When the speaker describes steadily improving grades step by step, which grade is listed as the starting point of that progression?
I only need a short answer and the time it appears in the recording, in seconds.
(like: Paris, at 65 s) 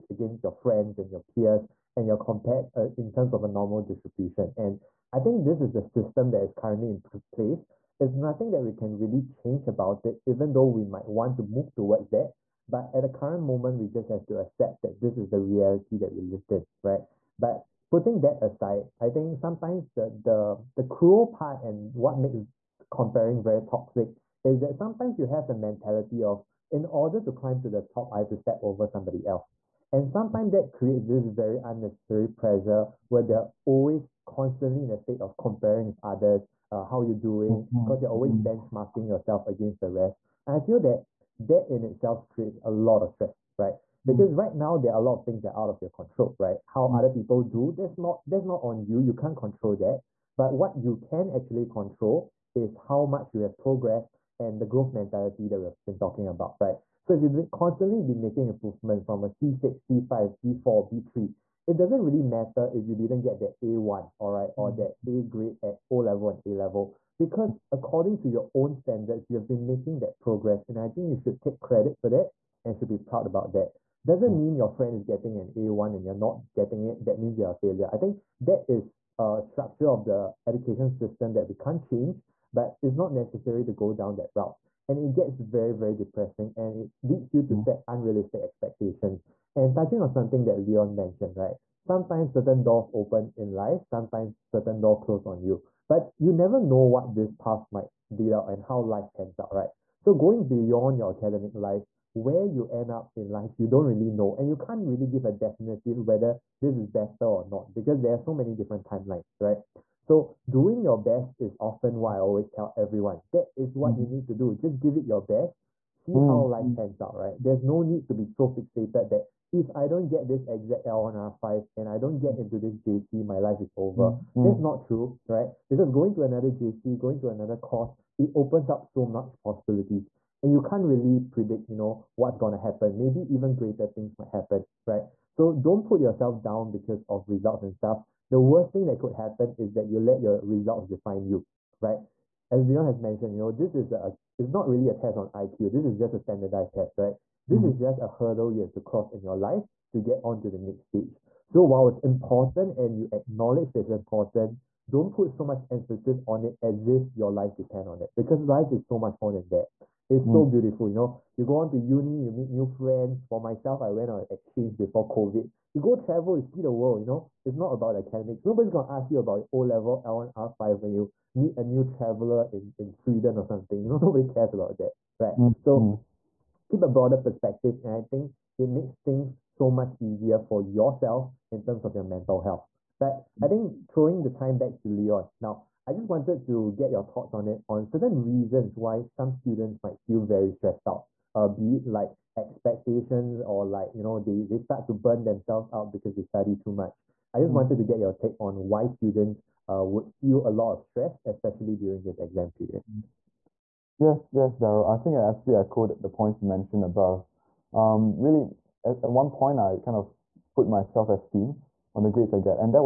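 C6, at 59 s.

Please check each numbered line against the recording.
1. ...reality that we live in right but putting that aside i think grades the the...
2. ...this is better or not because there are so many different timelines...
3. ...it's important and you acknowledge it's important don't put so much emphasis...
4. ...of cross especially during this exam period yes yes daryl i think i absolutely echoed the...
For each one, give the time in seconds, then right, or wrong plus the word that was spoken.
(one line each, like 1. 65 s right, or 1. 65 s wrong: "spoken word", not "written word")
1. 15 s wrong: "sometimes", not "grades"
2. 106 s right
3. 151 s right
4. 200 s wrong: "stress", not "cross".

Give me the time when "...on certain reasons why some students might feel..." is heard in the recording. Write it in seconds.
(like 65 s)
187 s.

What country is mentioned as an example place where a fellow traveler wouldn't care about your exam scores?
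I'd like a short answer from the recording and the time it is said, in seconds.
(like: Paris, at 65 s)
Sweden, at 172 s.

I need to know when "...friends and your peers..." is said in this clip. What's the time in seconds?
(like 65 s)
0 s.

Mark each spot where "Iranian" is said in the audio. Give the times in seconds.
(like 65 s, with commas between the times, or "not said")
not said.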